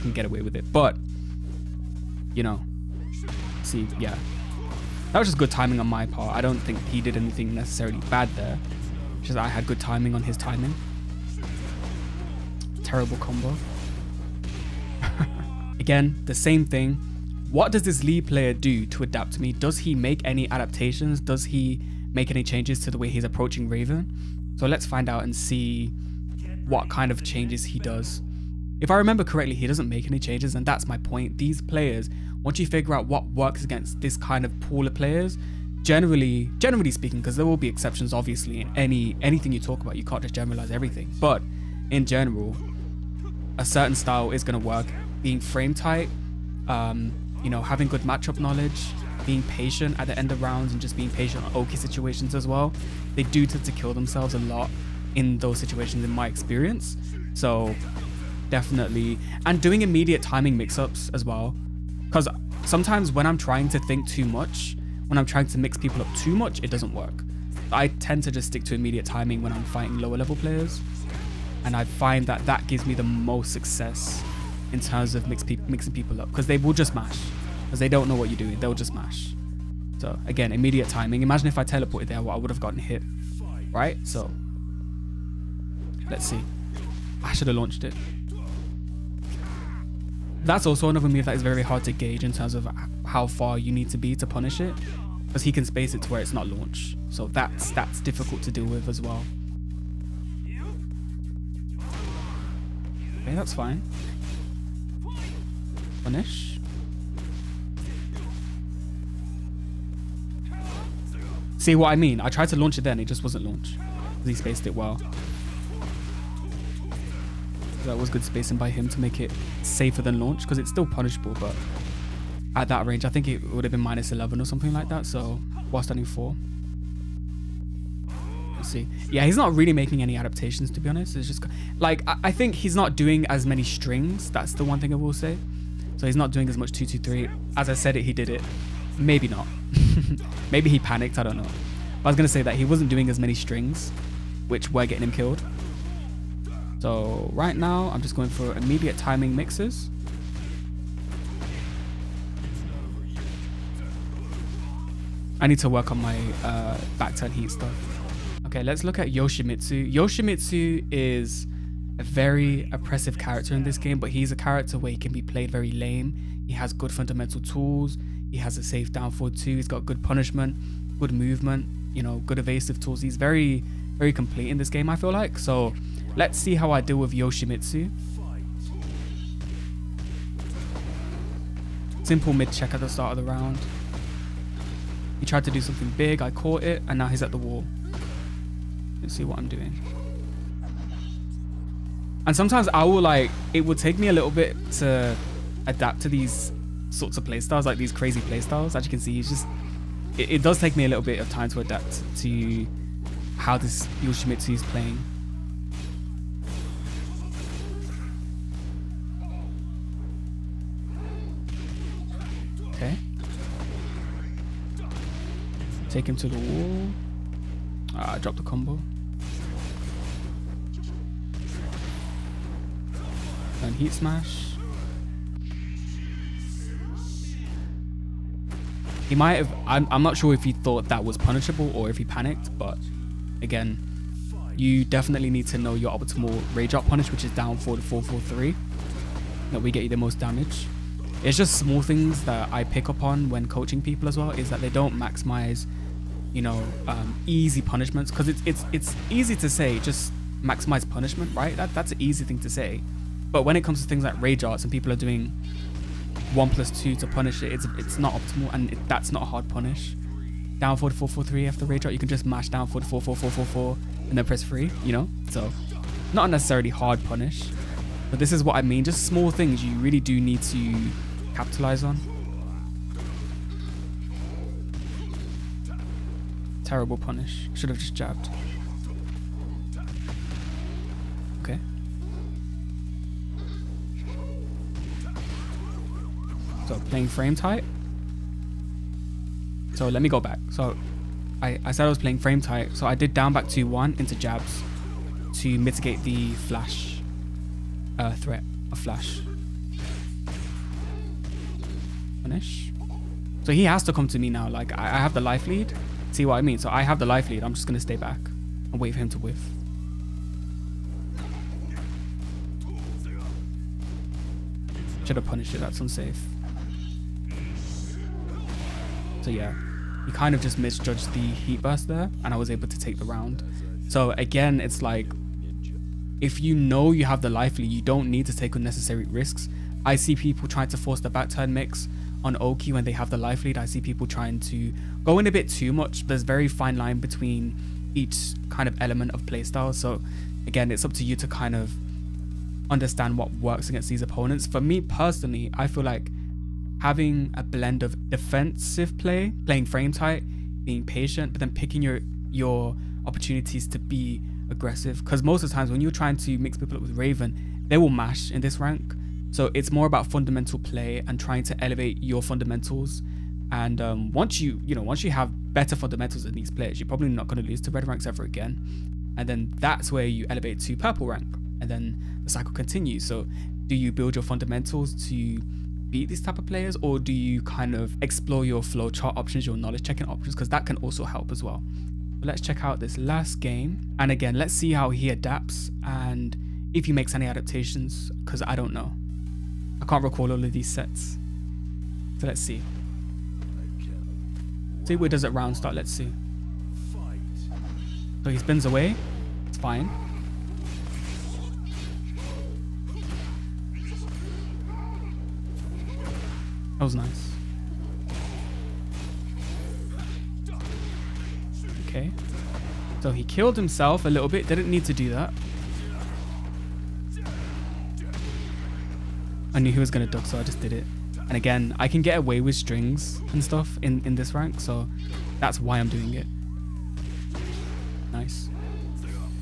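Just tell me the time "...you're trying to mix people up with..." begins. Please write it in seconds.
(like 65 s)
355 s.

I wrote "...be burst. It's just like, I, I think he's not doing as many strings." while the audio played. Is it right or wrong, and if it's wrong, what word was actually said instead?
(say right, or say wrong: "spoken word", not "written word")
wrong: "honest", not "burst".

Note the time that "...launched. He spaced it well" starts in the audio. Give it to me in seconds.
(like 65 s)
113 s.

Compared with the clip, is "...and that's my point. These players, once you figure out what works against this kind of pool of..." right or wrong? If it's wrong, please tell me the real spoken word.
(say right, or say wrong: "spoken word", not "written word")
right.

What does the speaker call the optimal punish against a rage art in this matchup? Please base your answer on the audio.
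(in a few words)
Down 4, 443.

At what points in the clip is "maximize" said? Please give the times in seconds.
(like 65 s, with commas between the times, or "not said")
244 s, 250 s.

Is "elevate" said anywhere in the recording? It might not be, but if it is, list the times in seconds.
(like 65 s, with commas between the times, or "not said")
361 s, 370 s.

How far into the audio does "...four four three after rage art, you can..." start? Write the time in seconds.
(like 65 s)
260 s.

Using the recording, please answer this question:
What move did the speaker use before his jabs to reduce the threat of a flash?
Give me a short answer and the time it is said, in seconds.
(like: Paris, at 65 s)
Down back 2-1, at 293 s.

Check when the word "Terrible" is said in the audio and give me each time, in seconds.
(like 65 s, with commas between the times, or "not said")
12 s, 276 s.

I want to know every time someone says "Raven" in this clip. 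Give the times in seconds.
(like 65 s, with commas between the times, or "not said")
23 s, 356 s.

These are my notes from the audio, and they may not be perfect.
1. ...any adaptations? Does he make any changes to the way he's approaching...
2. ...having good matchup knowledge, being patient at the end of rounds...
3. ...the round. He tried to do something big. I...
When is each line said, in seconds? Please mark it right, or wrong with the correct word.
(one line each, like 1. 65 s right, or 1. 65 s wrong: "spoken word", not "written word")
1. 20 s right
2. 47 s right
3. 183 s right.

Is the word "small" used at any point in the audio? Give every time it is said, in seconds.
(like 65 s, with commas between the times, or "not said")
241 s, 269 s.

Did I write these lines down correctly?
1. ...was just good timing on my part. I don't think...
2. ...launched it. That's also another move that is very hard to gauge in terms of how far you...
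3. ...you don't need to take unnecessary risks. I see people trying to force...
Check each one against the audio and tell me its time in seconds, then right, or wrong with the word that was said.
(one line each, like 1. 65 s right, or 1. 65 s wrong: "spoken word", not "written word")
1. 5 s right
2. 87 s right
3. 327 s right.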